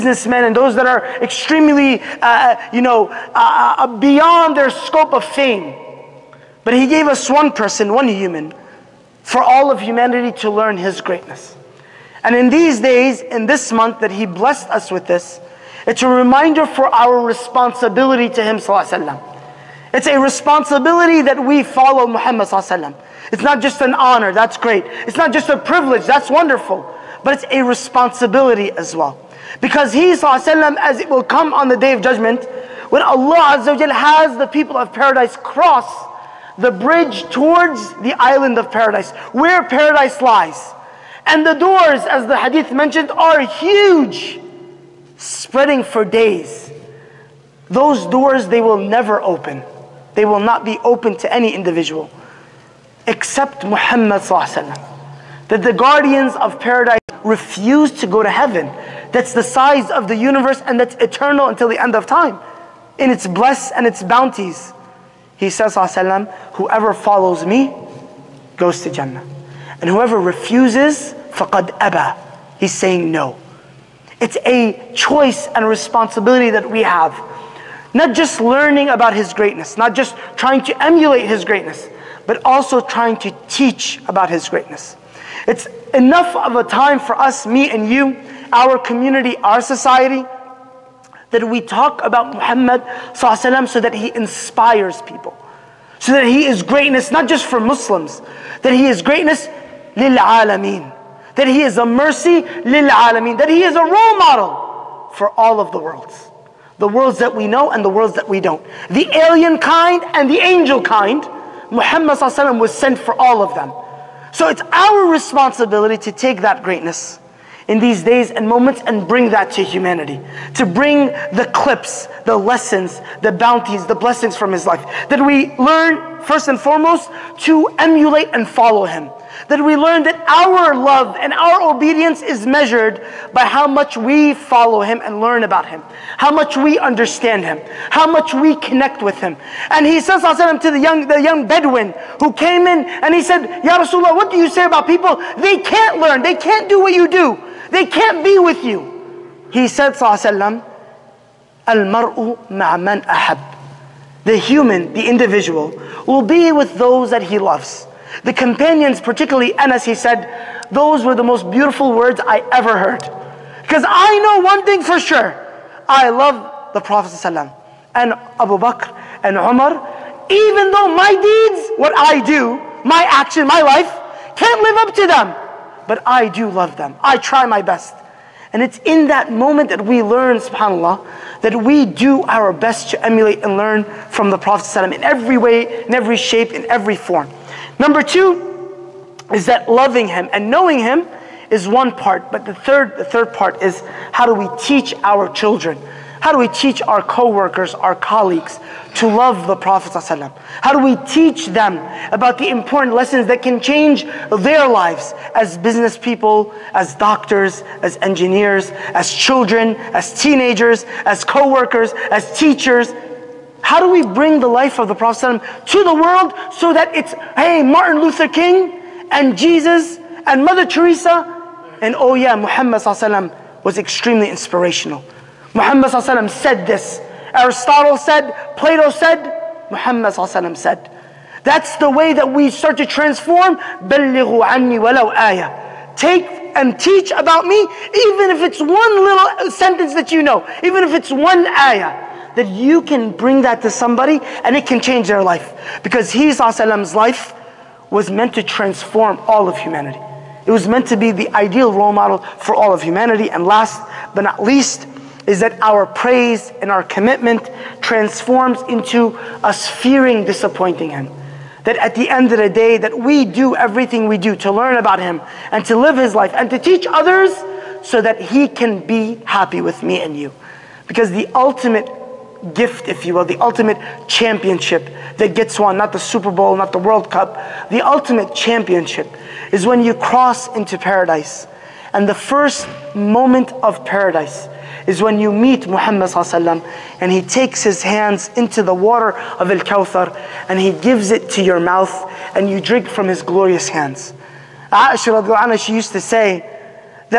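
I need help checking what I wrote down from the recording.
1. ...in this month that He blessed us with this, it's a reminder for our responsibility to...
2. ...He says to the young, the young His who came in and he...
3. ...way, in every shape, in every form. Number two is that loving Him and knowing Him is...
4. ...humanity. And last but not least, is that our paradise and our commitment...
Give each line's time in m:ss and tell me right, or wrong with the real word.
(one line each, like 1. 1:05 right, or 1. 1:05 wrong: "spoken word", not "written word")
1. 0:13 right
2. 2:19 wrong: "Bedouin", not "His"
3. 3:05 right
4. 4:12 wrong: "praise", not "paradise".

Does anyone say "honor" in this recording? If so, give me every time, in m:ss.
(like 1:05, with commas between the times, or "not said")
0:23.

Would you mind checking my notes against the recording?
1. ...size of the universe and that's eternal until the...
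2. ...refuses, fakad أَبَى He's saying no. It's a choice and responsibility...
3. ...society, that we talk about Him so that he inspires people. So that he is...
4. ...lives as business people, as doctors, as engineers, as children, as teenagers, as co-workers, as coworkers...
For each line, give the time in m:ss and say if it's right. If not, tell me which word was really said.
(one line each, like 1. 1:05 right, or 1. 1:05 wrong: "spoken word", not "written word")
1. 0:59 right
2. 1:10 right
3. 1:29 wrong: "Muhammad", not "Him"
4. 3:24 wrong: "teachers", not "coworkers".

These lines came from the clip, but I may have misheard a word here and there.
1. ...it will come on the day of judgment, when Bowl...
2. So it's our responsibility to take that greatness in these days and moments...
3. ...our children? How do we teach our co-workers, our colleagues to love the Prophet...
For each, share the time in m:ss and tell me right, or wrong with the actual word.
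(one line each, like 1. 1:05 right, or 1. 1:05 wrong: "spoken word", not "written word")
1. 0:30 wrong: "Allah", not "Bowl"
2. 1:54 right
3. 3:15 right.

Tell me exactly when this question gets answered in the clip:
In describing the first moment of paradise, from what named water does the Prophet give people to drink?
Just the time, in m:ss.
4:49.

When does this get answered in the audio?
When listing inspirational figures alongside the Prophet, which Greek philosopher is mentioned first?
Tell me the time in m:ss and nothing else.
3:47.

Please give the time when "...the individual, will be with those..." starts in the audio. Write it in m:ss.
2:34.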